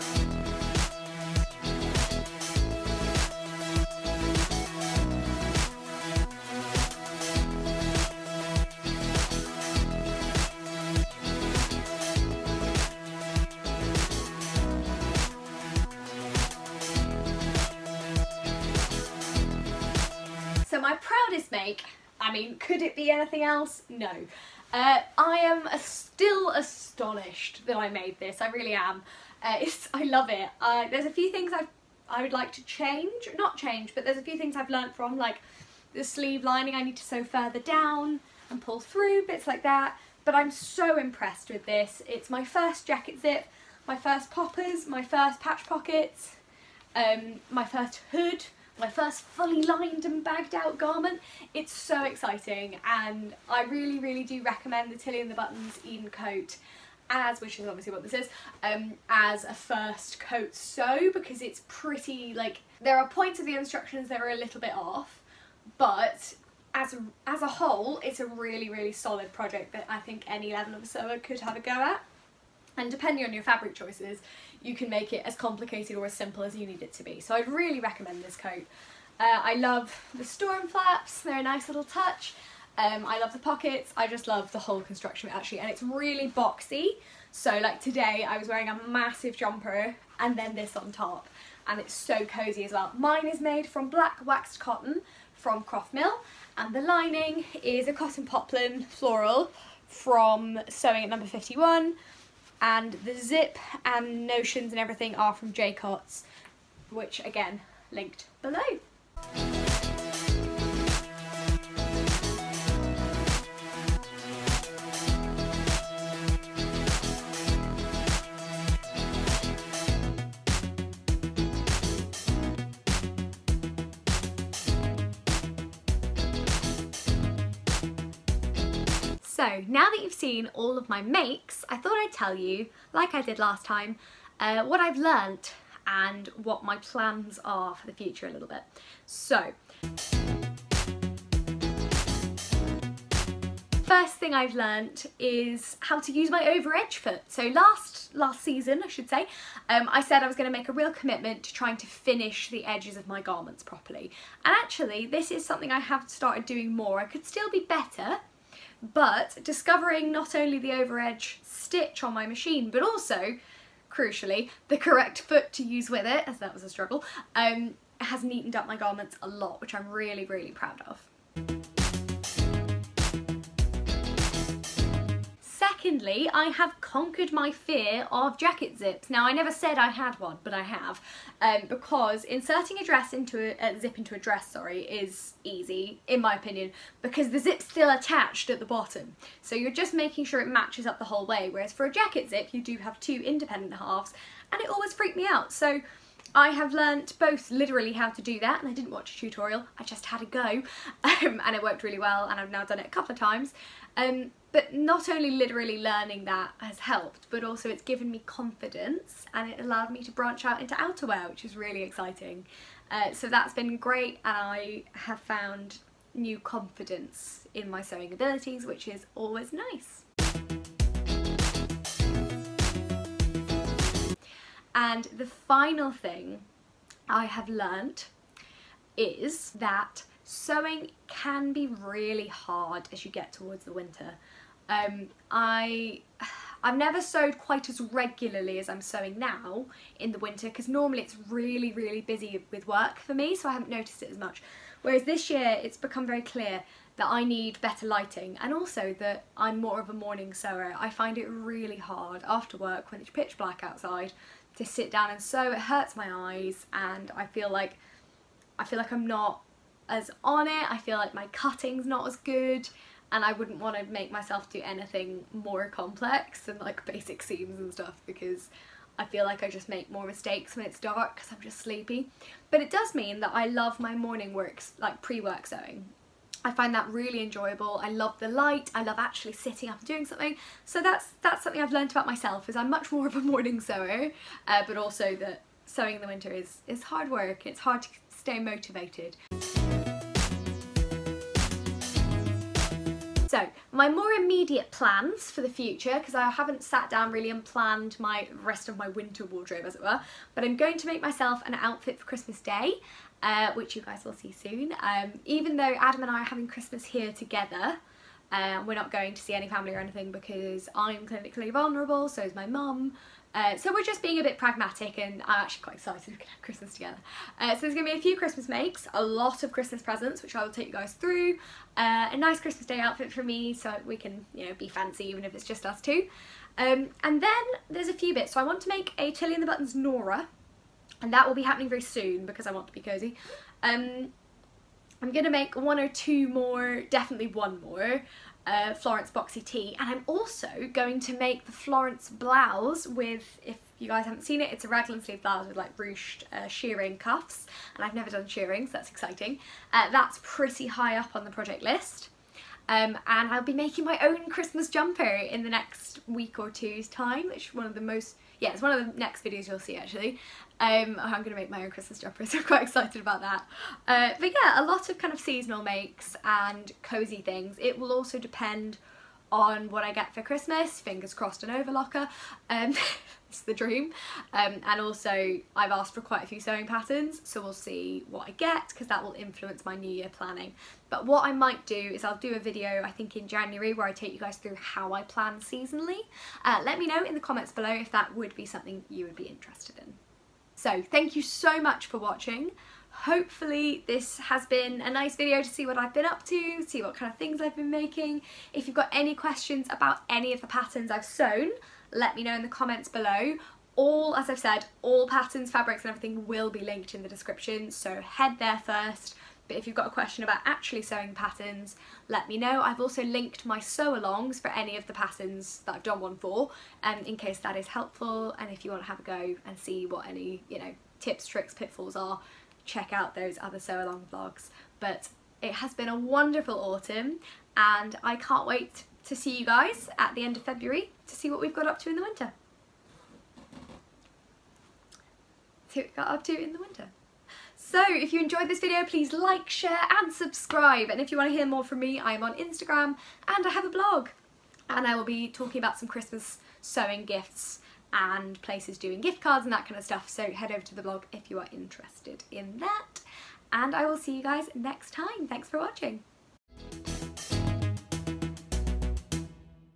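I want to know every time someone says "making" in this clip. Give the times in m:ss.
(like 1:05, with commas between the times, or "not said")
3:09, 5:53, 6:37.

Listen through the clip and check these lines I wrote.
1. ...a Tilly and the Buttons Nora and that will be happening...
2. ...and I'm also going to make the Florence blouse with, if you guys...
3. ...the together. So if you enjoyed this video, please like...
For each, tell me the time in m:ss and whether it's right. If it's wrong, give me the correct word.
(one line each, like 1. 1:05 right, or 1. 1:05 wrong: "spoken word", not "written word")
1. 5:28 right
2. 5:39 right
3. 7:16 wrong: "winter", not "together".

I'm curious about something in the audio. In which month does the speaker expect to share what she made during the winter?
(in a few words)
February.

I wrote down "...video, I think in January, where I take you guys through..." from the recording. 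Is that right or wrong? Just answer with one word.
right.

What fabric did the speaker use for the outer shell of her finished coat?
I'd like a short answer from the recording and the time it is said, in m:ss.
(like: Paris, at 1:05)
black waxed cotton, at 1:33.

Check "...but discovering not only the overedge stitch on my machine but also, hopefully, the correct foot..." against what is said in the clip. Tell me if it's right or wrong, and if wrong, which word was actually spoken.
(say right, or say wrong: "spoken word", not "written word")
wrong: "crucially", not "hopefully".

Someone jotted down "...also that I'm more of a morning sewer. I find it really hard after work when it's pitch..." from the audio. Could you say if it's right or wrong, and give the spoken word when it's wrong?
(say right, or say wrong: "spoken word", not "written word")
right.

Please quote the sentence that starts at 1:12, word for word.
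And depending on your fabric choices, you can make it as complicated or as simple as you need it to be.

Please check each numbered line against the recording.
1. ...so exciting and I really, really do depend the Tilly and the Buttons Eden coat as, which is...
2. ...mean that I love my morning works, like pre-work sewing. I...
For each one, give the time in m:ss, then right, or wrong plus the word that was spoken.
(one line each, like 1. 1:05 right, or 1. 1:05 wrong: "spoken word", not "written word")
1. 0:51 wrong: "recommend", not "depend"
2. 4:32 right.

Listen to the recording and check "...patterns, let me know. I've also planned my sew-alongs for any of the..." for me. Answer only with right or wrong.
wrong.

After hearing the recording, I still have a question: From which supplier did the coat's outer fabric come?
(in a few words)
Croft Mill.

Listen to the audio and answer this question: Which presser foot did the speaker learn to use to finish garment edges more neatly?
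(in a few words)
over edge foot.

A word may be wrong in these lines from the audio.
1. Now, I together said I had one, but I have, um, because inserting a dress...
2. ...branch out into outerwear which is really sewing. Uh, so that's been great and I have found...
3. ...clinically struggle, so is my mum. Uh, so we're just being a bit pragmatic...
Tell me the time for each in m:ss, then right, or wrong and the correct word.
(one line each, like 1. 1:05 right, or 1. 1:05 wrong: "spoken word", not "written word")
1. 2:59 wrong: "never", not "together"
2. 3:30 wrong: "exciting", not "sewing"
3. 5:11 wrong: "vulnerable", not "struggle".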